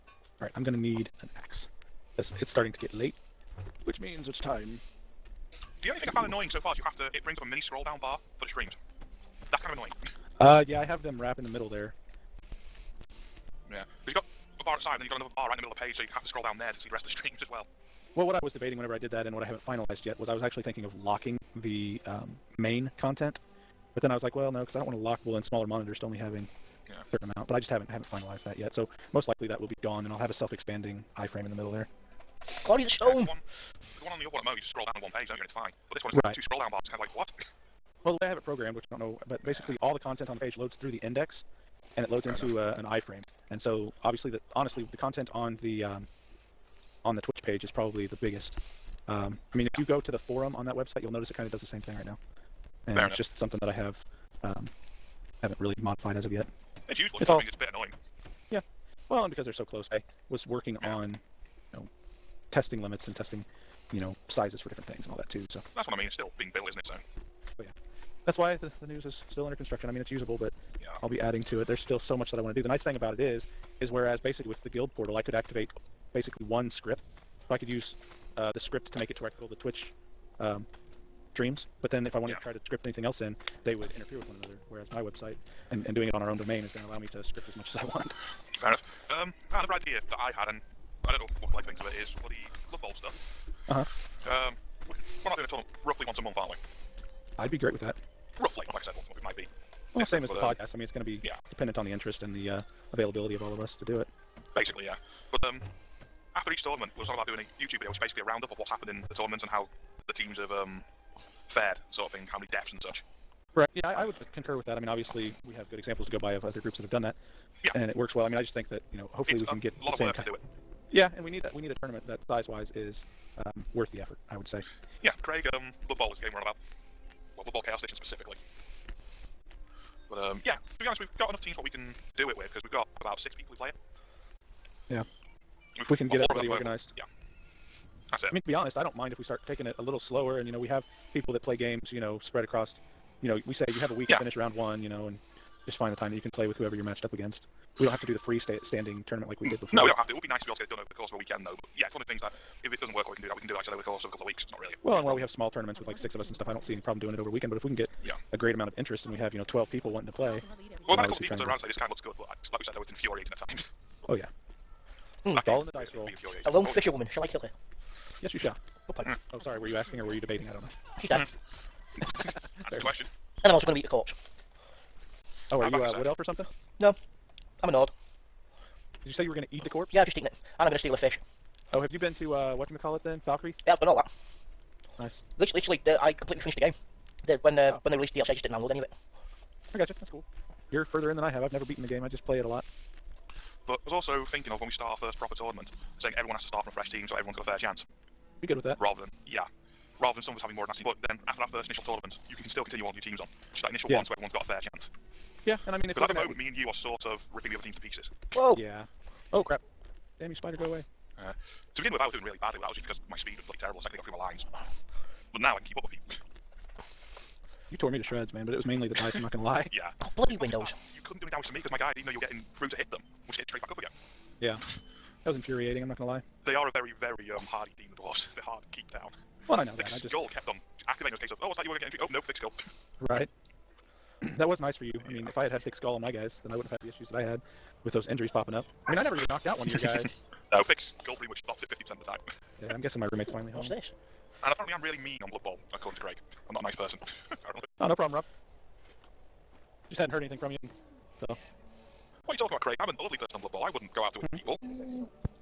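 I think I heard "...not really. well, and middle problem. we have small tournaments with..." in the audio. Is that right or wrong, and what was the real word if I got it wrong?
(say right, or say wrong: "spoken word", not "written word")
wrong: "while", not "middle".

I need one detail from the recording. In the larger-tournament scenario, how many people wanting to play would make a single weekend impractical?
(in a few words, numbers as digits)
12.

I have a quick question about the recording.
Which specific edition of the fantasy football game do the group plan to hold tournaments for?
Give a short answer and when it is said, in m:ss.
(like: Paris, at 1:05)
Blood Bowl Chaos Edition, at 2:07.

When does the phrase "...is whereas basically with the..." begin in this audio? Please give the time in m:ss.
1:13.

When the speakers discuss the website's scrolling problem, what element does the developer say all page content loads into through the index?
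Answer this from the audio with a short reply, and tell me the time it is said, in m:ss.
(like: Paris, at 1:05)
an iframe, at 0:42.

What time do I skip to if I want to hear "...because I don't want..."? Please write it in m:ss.
0:24.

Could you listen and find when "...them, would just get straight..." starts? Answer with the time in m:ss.
3:42.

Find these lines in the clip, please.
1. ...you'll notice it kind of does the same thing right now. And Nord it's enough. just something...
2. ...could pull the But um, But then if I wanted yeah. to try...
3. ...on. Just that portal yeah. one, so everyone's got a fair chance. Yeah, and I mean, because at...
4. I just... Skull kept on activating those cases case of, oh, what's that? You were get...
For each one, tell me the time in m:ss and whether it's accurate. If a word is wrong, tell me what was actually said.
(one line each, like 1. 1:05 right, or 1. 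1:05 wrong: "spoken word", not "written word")
1. 0:51 wrong: "Fair", not "Nord"
2. 1:19 wrong: "Twitch", not "But"
3. 3:23 wrong: "initial", not "portal"
4. 3:49 right.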